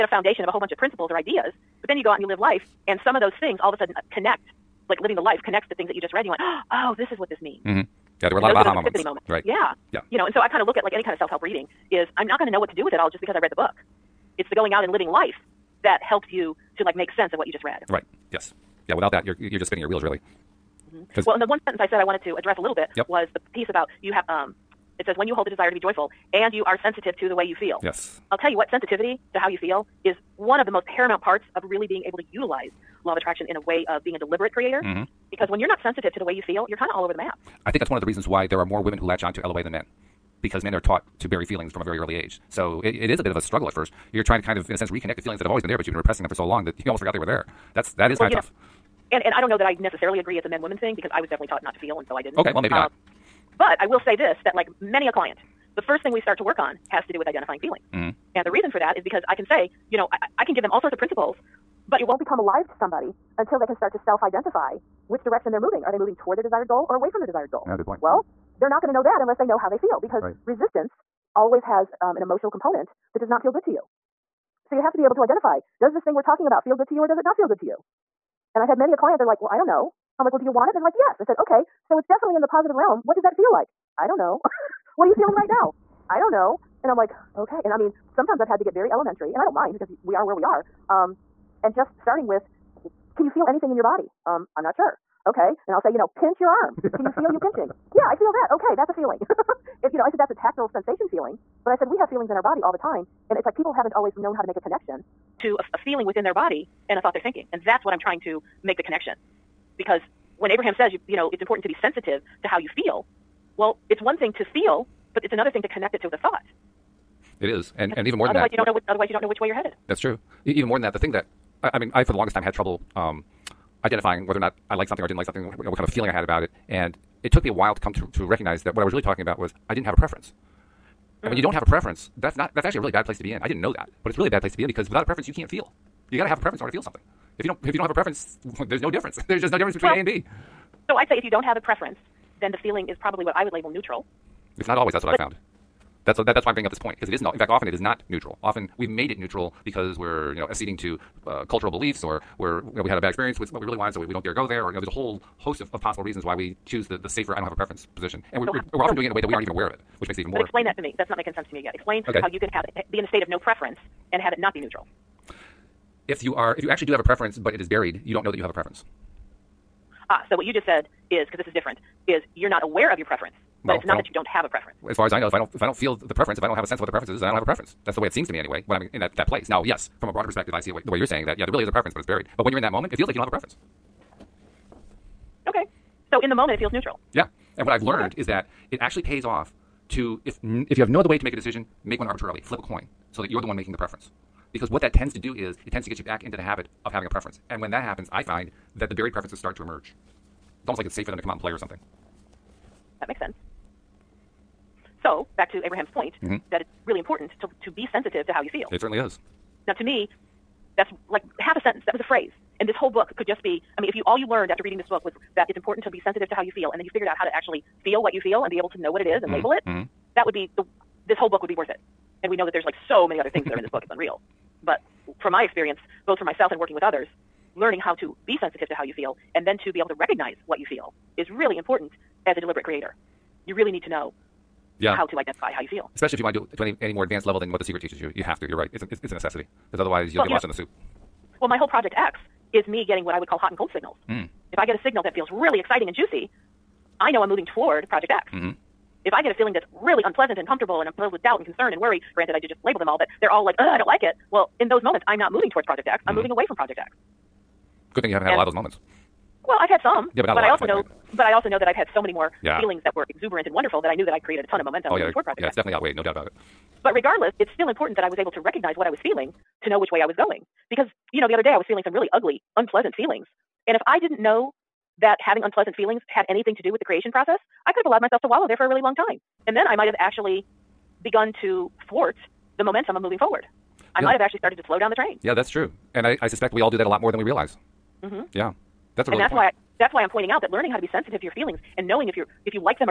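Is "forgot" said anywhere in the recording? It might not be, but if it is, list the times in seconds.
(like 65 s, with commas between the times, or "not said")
46 s.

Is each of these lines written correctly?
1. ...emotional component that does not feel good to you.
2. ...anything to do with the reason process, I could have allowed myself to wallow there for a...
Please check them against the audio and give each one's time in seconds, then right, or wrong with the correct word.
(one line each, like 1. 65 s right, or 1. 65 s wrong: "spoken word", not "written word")
1. 72 s right
2. 276 s wrong: "creation", not "reason".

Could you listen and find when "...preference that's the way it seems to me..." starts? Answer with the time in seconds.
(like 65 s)
177 s.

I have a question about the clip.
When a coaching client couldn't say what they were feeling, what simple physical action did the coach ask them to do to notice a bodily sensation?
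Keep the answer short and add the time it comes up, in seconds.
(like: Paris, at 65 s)
Pinch your arm, at 96 s.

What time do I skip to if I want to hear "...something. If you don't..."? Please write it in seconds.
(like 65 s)
136 s.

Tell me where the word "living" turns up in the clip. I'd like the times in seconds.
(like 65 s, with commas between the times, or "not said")
4 s, 14 s.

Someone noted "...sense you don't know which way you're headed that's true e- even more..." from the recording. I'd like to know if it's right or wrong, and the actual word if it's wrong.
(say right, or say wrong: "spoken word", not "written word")
wrong: "otherwise", not "sense".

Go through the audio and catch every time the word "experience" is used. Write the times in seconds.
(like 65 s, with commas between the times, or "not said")
153 s, 225 s.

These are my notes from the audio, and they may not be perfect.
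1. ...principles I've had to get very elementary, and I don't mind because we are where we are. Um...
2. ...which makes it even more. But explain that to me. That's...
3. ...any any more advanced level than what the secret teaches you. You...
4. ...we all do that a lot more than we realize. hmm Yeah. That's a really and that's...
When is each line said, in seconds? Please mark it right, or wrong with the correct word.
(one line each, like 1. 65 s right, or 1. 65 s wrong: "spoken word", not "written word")
1. 88 s wrong: "sometimes", not "principles"
2. 159 s right
3. 236 s right
4. 286 s right.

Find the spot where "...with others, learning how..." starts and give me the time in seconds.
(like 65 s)
226 s.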